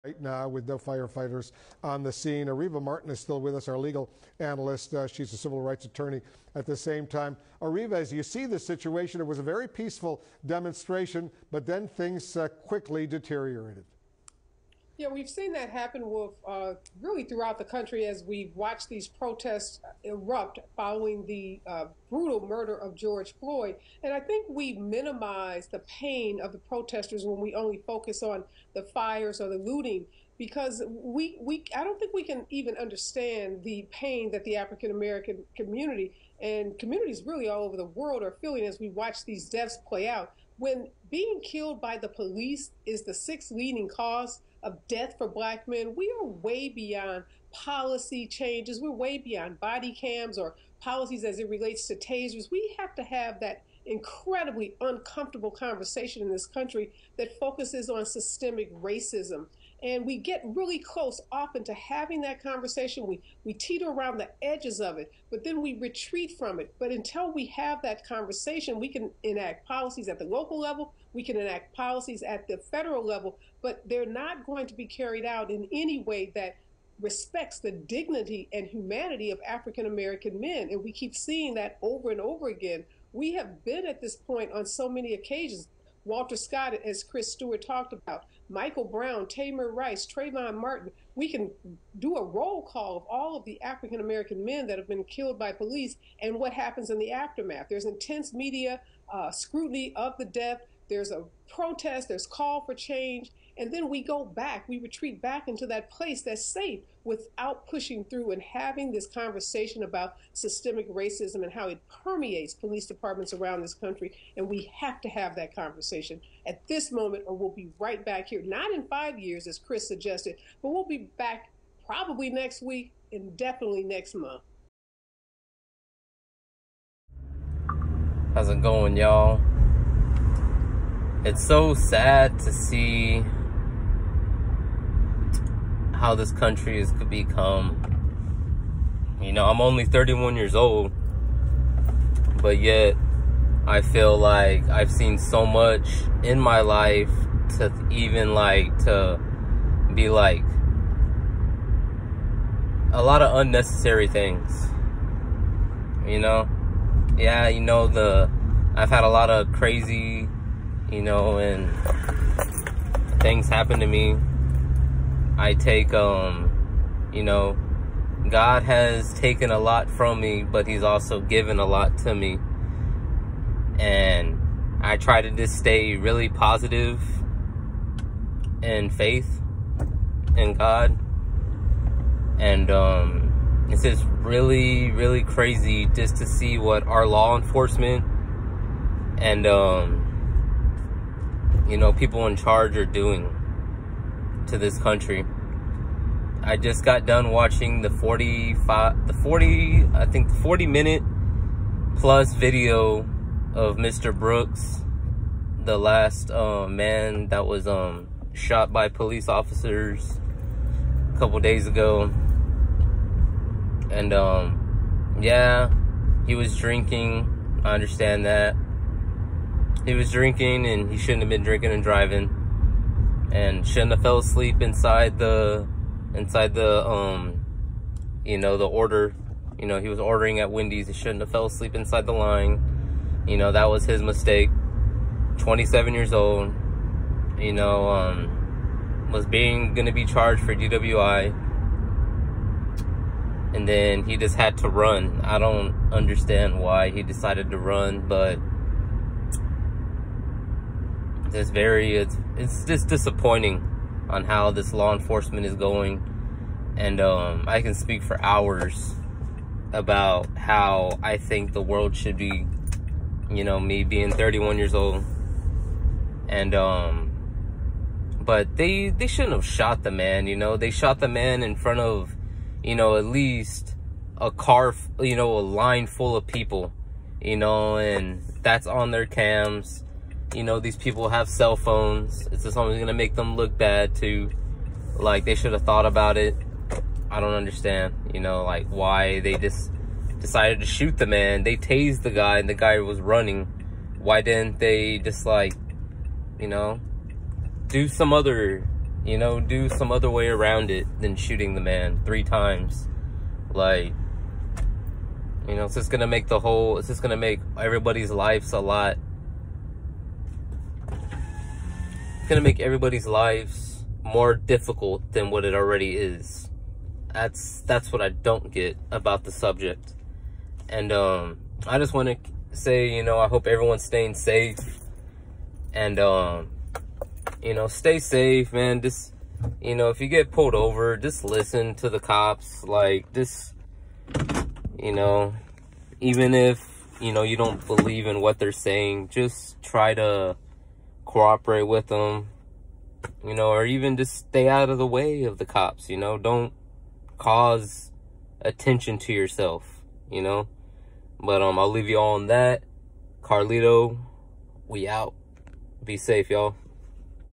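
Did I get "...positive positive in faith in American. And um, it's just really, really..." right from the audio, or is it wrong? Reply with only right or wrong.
wrong.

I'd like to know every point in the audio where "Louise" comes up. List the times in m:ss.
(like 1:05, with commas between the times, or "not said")
not said.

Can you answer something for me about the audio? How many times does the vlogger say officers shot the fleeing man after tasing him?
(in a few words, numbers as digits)
3 times.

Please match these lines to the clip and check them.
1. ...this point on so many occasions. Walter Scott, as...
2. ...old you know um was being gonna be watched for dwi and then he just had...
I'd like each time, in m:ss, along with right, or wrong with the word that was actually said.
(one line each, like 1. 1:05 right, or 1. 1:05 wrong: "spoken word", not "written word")
1. 1:24 right
2. 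3:56 wrong: "charged", not "watched".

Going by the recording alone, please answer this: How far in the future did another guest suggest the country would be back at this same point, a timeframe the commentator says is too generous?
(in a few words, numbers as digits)
5 years.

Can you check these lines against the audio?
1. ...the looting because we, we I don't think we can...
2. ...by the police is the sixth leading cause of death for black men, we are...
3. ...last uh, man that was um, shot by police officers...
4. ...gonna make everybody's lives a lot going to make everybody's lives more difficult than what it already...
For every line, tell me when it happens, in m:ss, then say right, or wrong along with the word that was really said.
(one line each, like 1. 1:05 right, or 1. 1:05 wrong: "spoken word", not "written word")
1. 0:29 right
2. 0:41 right
3. 3:25 right
4. 5:07 right.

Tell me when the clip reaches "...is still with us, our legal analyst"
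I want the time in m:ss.
0:03.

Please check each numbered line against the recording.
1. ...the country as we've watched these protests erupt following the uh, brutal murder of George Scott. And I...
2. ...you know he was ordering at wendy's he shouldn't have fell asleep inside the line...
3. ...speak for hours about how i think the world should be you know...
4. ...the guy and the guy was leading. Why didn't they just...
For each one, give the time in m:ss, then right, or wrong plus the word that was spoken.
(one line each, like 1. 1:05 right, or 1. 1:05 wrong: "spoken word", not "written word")
1. 0:17 wrong: "Floyd", not "Scott"
2. 3:49 right
3. 4:17 right
4. 4:52 wrong: "running", not "leading".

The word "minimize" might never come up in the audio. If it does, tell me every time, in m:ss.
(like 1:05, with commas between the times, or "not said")
0:24.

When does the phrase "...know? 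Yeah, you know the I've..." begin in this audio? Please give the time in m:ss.
2:36.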